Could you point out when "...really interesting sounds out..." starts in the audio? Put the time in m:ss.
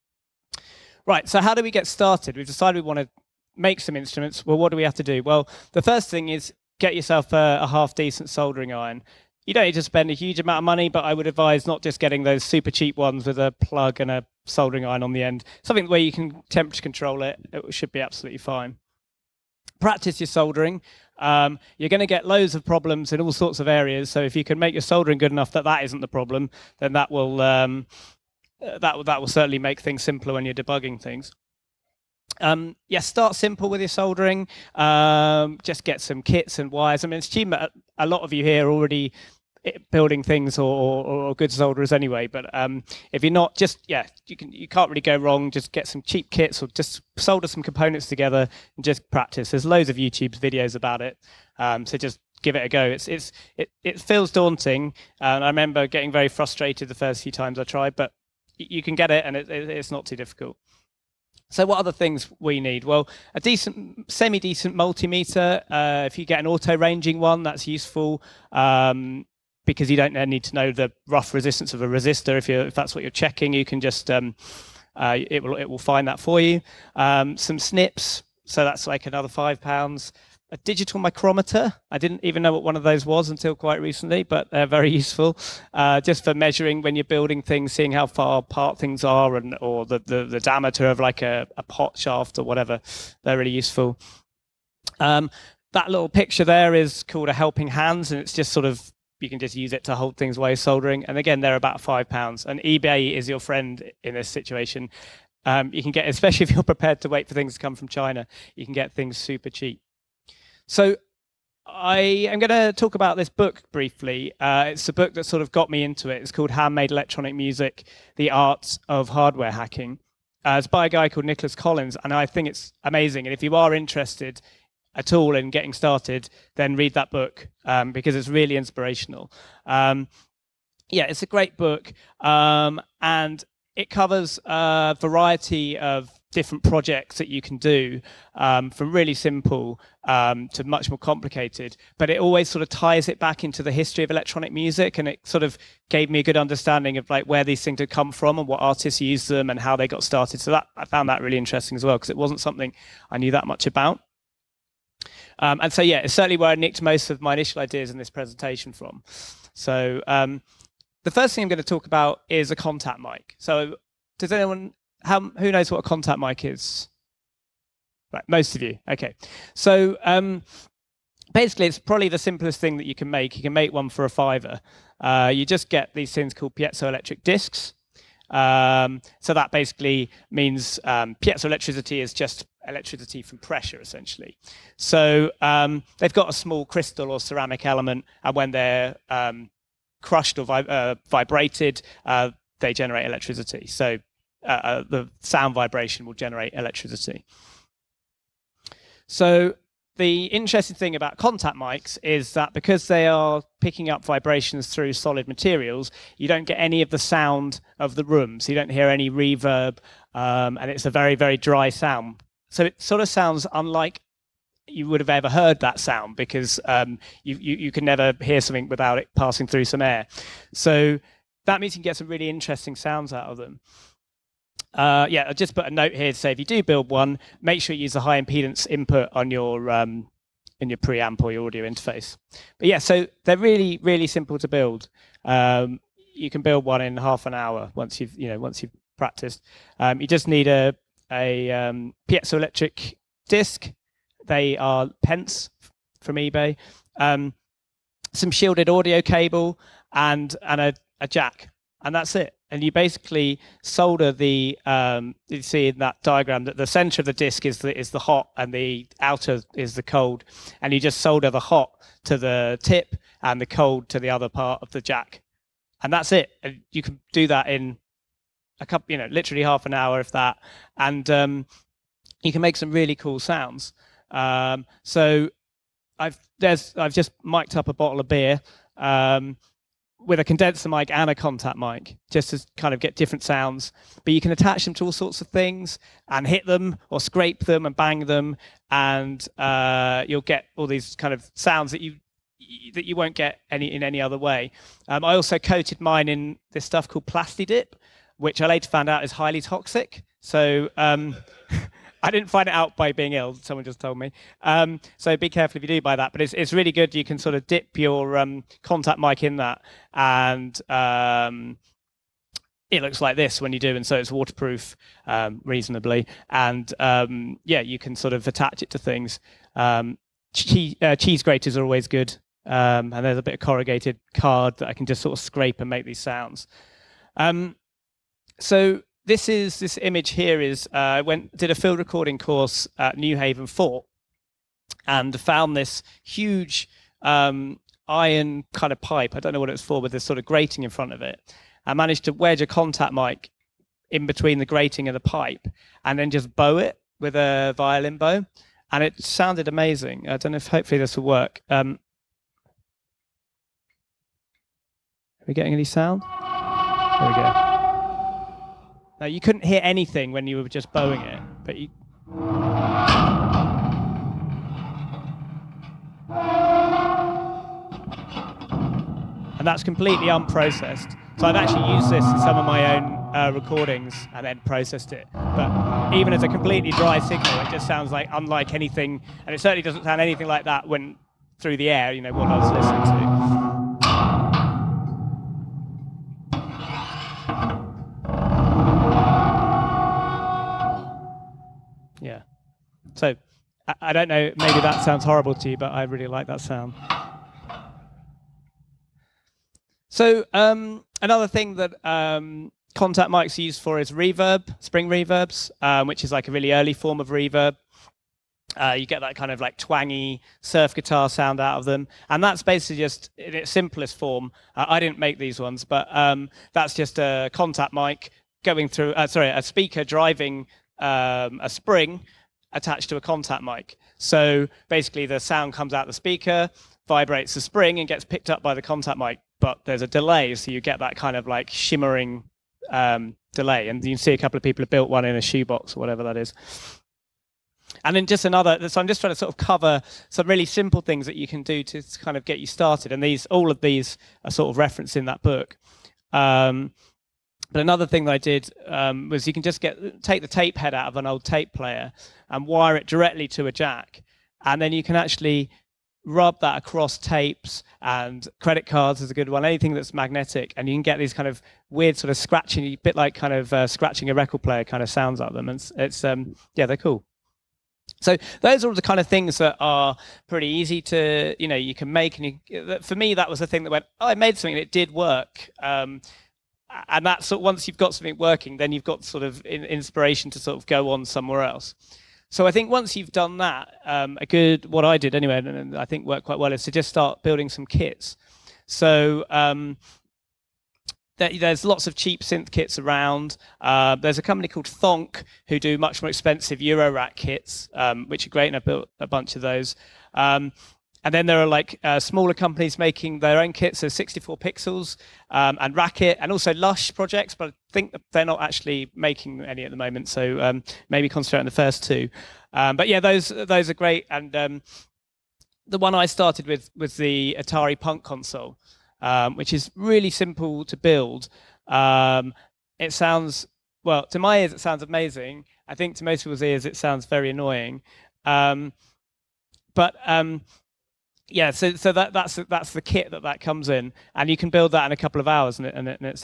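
3:42.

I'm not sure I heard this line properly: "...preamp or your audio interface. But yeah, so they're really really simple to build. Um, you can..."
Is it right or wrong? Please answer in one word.
right.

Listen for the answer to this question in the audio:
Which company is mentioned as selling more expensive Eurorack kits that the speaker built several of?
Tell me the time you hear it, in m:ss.
8:14.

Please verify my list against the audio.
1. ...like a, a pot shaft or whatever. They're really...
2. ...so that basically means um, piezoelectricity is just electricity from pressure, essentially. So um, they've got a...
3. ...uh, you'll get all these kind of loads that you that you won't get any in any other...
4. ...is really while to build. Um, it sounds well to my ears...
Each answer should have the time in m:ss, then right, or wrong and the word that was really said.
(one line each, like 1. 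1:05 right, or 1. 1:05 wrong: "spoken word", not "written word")
1. 1:30 right
2. 2:59 right
3. 4:49 wrong: "sounds", not "loads"
4. 8:39 wrong: "simple", not "while".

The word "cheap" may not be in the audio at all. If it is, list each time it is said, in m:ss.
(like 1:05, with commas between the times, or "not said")
0:12, 0:46, 1:49, 8:11.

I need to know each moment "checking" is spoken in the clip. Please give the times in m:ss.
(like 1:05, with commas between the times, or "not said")
1:13.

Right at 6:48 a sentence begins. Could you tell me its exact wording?
Uh, you get that kind of like twangy surf guitar sound out of them, and that's basically just in its simplest form.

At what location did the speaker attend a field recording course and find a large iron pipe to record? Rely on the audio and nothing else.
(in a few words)
Newhaven Fort.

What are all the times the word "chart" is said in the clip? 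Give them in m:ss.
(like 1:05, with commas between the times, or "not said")
not said.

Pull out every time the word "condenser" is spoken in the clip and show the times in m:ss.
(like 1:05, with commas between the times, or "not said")
4:40.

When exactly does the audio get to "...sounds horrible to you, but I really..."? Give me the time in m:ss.
6:34.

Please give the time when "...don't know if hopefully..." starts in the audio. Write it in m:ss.
5:50.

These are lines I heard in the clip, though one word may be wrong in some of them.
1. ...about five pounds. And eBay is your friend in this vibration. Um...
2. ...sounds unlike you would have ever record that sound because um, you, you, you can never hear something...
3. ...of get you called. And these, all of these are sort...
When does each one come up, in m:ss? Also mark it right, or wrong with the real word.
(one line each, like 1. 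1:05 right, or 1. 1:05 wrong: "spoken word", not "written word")
1. 1:41 wrong: "situation", not "vibration"
2. 3:33 wrong: "heard", not "record"
3. 7:22 wrong: "started", not "called".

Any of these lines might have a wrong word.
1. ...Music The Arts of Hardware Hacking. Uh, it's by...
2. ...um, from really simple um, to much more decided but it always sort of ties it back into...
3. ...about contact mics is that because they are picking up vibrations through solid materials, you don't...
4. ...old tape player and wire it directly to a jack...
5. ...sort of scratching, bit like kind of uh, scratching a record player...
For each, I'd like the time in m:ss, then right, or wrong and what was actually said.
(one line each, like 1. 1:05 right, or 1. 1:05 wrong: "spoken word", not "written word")
1. 1:57 right
2. 2:18 wrong: "complicated", not "decided"
3. 3:20 right
4. 7:31 right
5. 7:41 right.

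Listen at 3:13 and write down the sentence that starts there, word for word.
So uh, uh, the sound vibration will generate electricity.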